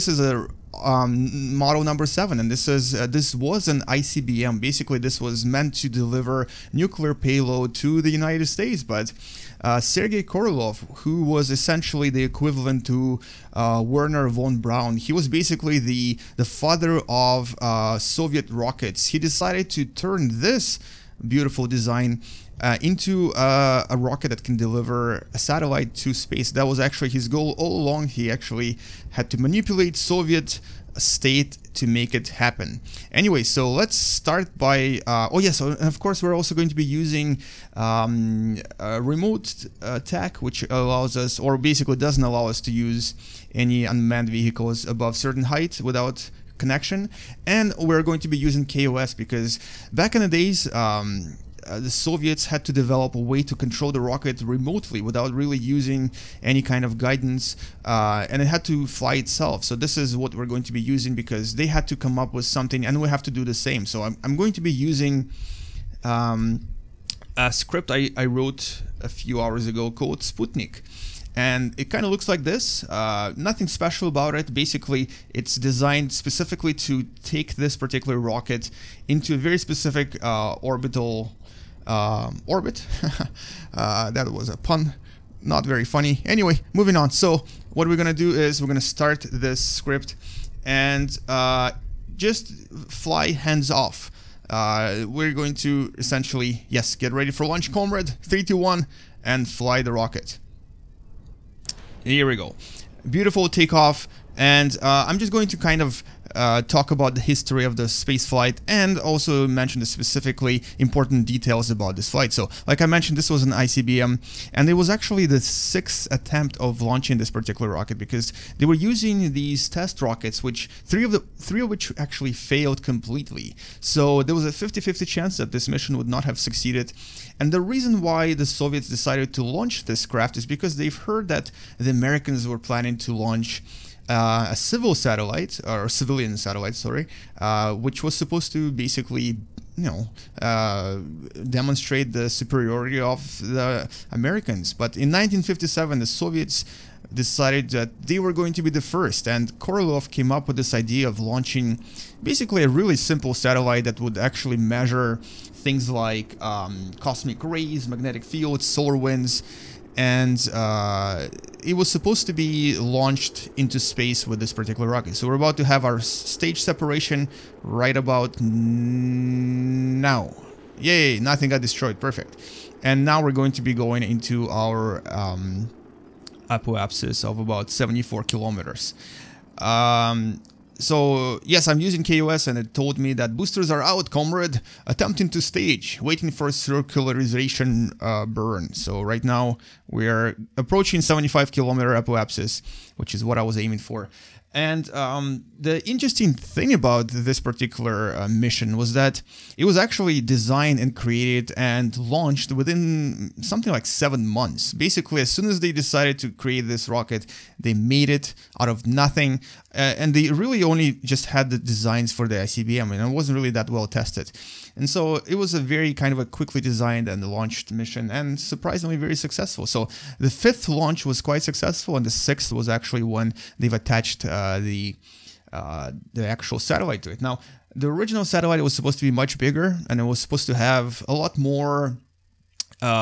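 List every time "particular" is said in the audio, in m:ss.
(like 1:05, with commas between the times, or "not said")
1:17, 1:57, 2:44, 3:17.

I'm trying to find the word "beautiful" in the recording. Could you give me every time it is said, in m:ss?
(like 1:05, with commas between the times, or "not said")
0:21, 1:43.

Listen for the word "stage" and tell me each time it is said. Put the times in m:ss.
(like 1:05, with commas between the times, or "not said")
2:46, 3:05.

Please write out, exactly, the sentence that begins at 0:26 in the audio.
That was actually his goal all along.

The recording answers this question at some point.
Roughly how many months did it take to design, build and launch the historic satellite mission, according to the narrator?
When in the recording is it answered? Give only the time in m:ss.
3:23.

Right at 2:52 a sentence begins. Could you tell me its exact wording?
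And now we're going to be going into our um, apoapsis of about 74 kilometers.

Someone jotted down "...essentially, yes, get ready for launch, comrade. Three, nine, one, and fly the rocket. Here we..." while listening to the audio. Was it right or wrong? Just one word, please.
wrong.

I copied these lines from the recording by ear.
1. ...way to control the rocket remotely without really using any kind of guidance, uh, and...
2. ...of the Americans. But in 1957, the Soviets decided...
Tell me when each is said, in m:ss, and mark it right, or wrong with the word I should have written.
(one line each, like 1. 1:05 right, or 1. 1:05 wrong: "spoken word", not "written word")
1. 0:53 right
2. 2:23 right.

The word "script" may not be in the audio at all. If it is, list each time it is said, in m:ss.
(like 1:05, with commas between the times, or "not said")
1:07, 1:29.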